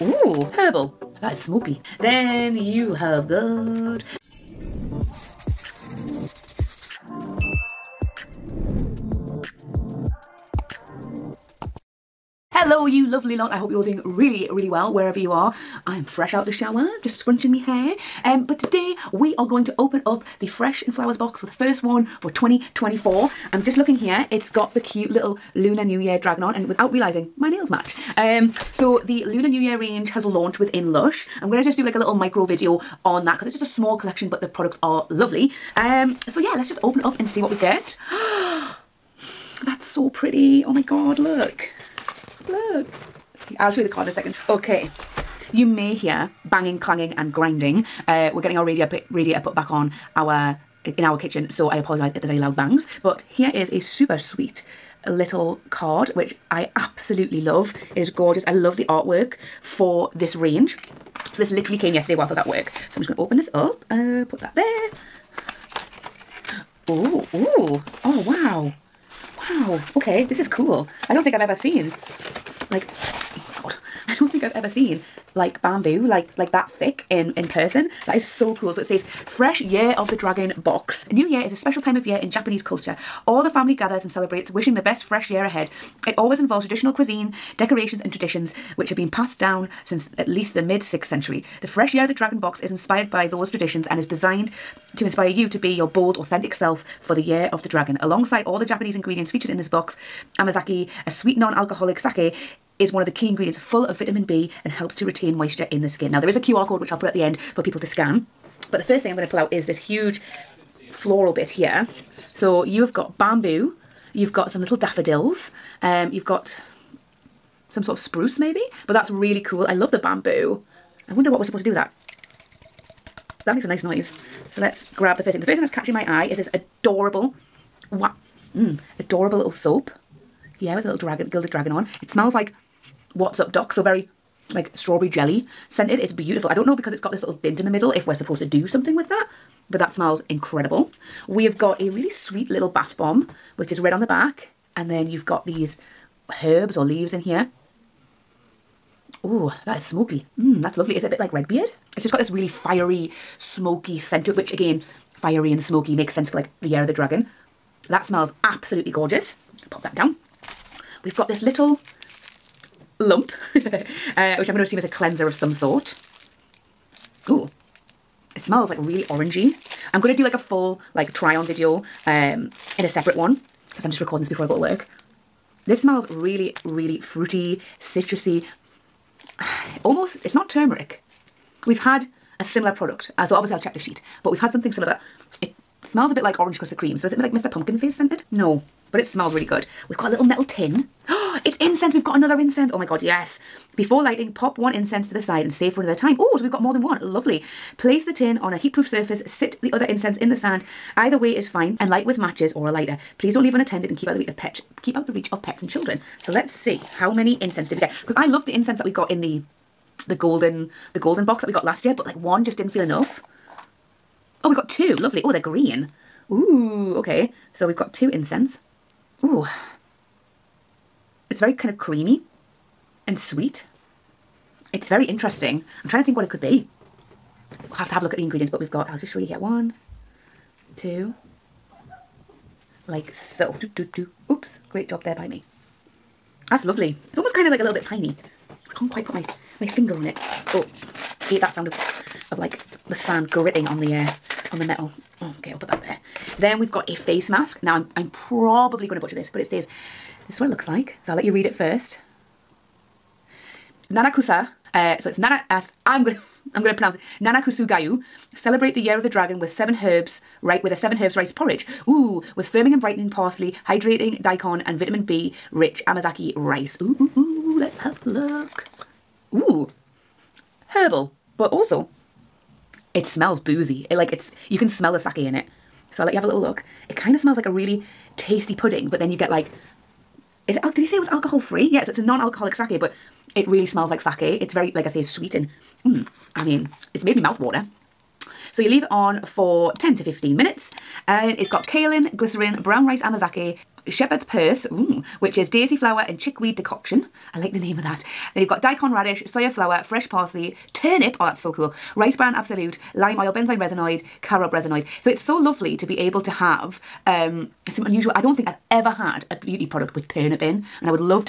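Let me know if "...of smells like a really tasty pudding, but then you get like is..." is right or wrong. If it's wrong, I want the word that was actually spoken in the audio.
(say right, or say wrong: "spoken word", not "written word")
right.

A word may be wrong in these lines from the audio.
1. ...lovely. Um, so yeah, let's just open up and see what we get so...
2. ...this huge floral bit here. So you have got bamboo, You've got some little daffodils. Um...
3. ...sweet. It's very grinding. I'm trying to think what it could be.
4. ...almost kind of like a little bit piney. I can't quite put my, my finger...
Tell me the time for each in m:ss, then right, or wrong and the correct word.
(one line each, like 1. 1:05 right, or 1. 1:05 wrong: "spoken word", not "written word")
1. 0:35 right
2. 1:49 right
3. 3:43 wrong: "interesting", not "grinding"
4. 3:57 right.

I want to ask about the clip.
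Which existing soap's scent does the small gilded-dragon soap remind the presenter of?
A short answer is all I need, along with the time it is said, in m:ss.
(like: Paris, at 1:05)
What's Up Doc, at 2:13.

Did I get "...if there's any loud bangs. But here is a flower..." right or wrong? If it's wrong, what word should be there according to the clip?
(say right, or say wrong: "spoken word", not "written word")
wrong: "super", not "flower".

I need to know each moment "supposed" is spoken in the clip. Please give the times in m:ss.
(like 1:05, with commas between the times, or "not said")
2:01, 2:18.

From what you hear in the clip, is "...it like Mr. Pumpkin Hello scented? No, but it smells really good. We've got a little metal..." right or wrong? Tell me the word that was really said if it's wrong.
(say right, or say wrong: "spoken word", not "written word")
wrong: "Face", not "Hello".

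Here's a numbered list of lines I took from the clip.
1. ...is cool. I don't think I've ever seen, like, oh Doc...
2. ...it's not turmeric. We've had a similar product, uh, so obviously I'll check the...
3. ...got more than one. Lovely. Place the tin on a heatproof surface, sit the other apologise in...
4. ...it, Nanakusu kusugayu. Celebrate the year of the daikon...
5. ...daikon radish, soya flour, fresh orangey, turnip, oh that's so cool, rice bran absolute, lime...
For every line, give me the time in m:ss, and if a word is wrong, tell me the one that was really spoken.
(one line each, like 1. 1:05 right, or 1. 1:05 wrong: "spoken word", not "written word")
1. 1:10 wrong: "God", not "Doc"
2. 3:00 right
3. 3:16 wrong: "incense", not "apologise"
4. 4:16 wrong: "dragon", not "daikon"
5. 4:58 wrong: "parsley", not "orangey".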